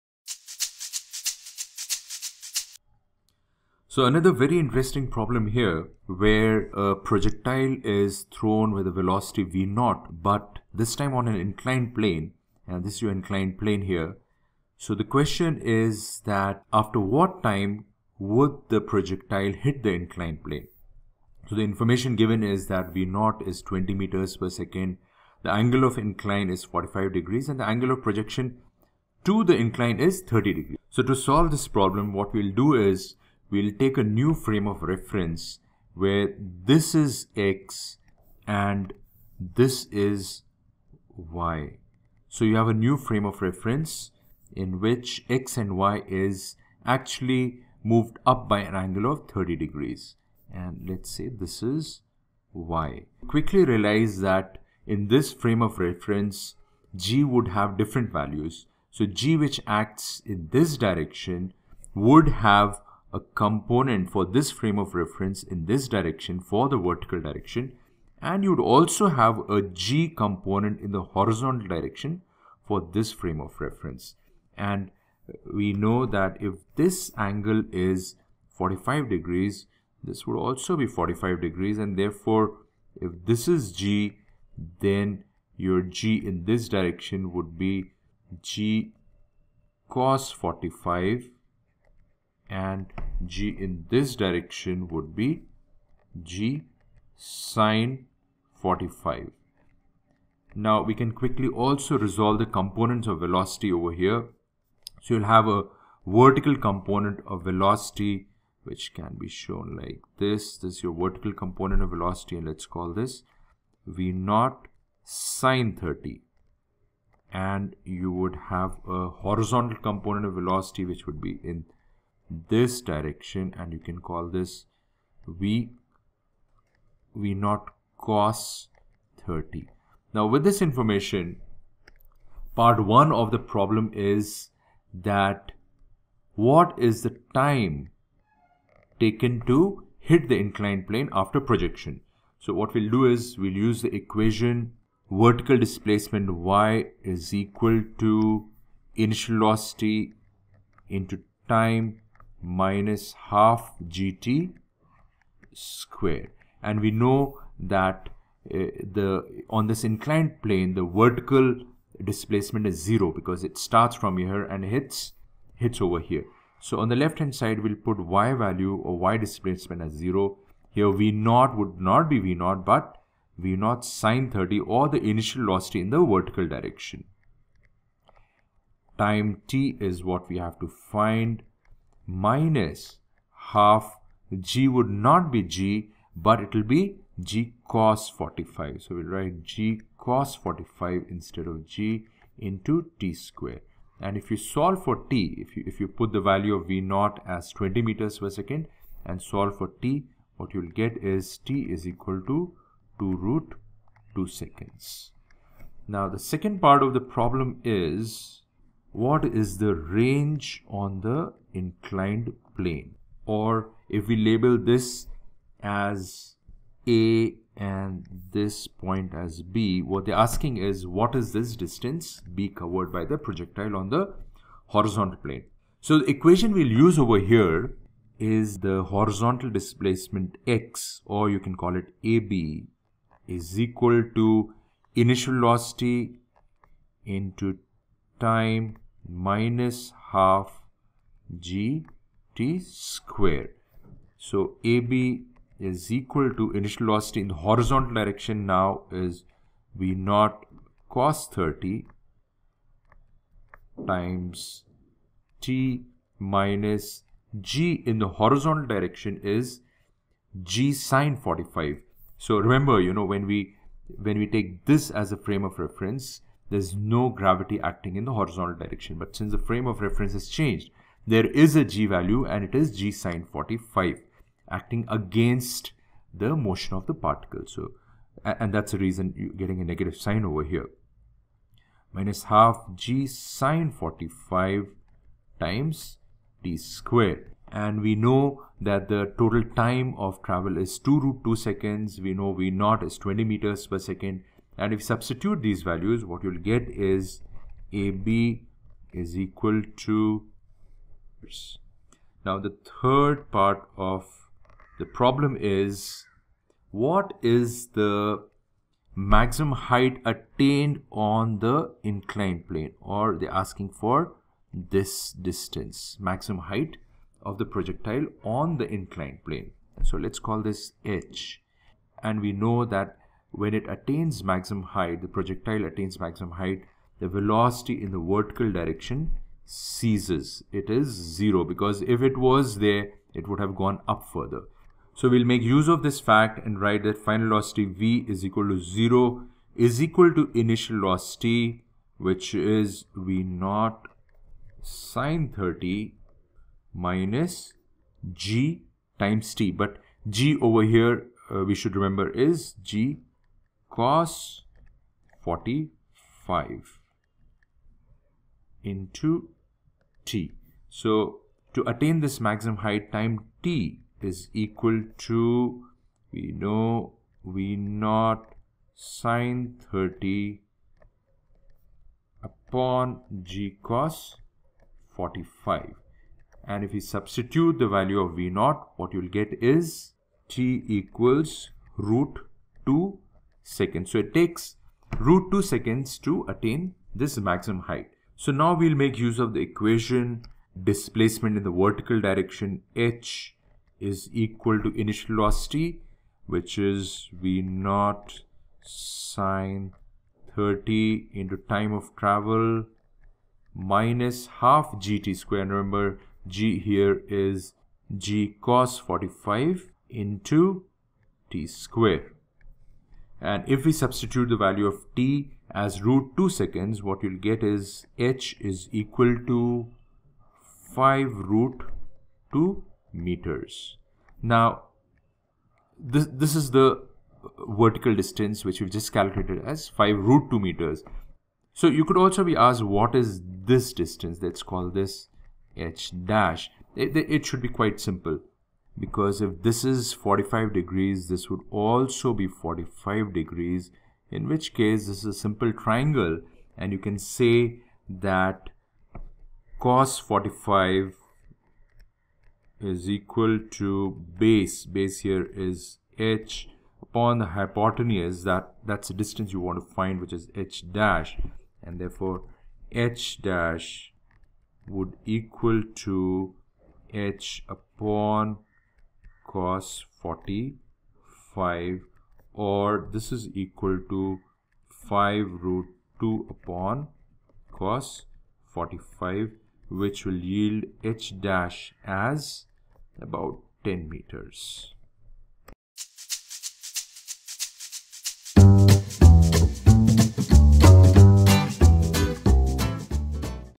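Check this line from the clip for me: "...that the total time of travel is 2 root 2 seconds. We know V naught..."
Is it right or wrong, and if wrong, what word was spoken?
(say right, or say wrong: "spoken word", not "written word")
right.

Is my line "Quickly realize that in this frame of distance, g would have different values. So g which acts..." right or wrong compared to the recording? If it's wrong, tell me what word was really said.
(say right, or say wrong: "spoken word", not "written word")
wrong: "reference", not "distance".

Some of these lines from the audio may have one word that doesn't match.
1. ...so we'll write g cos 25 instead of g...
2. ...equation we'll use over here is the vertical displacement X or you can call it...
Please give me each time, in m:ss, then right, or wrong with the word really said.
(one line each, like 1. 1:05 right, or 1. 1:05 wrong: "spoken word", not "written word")
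1. 3:08 wrong: "45", not "25"
2. 3:46 wrong: "horizontal", not "vertical".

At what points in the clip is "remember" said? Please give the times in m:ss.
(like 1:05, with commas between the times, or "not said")
4:22, 5:51, 6:45.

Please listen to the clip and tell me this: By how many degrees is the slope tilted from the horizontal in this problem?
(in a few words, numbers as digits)
45 degrees.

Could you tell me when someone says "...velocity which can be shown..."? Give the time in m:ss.
1:47.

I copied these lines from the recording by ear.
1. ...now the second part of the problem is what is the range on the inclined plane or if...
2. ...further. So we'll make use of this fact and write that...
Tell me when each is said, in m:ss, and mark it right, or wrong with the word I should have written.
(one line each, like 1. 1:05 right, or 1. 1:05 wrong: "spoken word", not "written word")
1. 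3:25 right
2. 5:34 right.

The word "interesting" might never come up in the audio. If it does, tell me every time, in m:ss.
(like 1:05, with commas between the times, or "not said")
0:04.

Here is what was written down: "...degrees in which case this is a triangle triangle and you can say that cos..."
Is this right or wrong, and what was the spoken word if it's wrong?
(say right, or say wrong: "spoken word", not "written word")
wrong: "simple", not "triangle".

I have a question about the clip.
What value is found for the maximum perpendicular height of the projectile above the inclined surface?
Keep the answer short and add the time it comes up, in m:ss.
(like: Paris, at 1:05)
5 root 2 meters, at 6:57.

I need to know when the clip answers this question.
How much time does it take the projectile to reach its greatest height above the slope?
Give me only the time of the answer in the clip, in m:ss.
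6:20.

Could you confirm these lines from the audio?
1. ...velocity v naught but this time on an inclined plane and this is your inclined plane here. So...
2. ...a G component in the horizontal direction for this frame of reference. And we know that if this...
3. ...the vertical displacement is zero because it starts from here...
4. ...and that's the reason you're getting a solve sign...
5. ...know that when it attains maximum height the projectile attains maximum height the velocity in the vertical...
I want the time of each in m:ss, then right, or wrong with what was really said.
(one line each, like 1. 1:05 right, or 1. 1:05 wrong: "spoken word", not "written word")
1. 0:08 right
2. 1:09 right
3. 2:40 right
4. 4:38 wrong: "negative", not "solve"
5. 5:22 right.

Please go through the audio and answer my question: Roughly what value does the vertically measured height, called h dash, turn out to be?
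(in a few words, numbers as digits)
about 10 meters.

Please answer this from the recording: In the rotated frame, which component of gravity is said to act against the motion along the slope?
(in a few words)
g sine 45.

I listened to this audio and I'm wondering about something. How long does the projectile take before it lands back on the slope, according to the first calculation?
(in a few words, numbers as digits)
2 root 2 seconds.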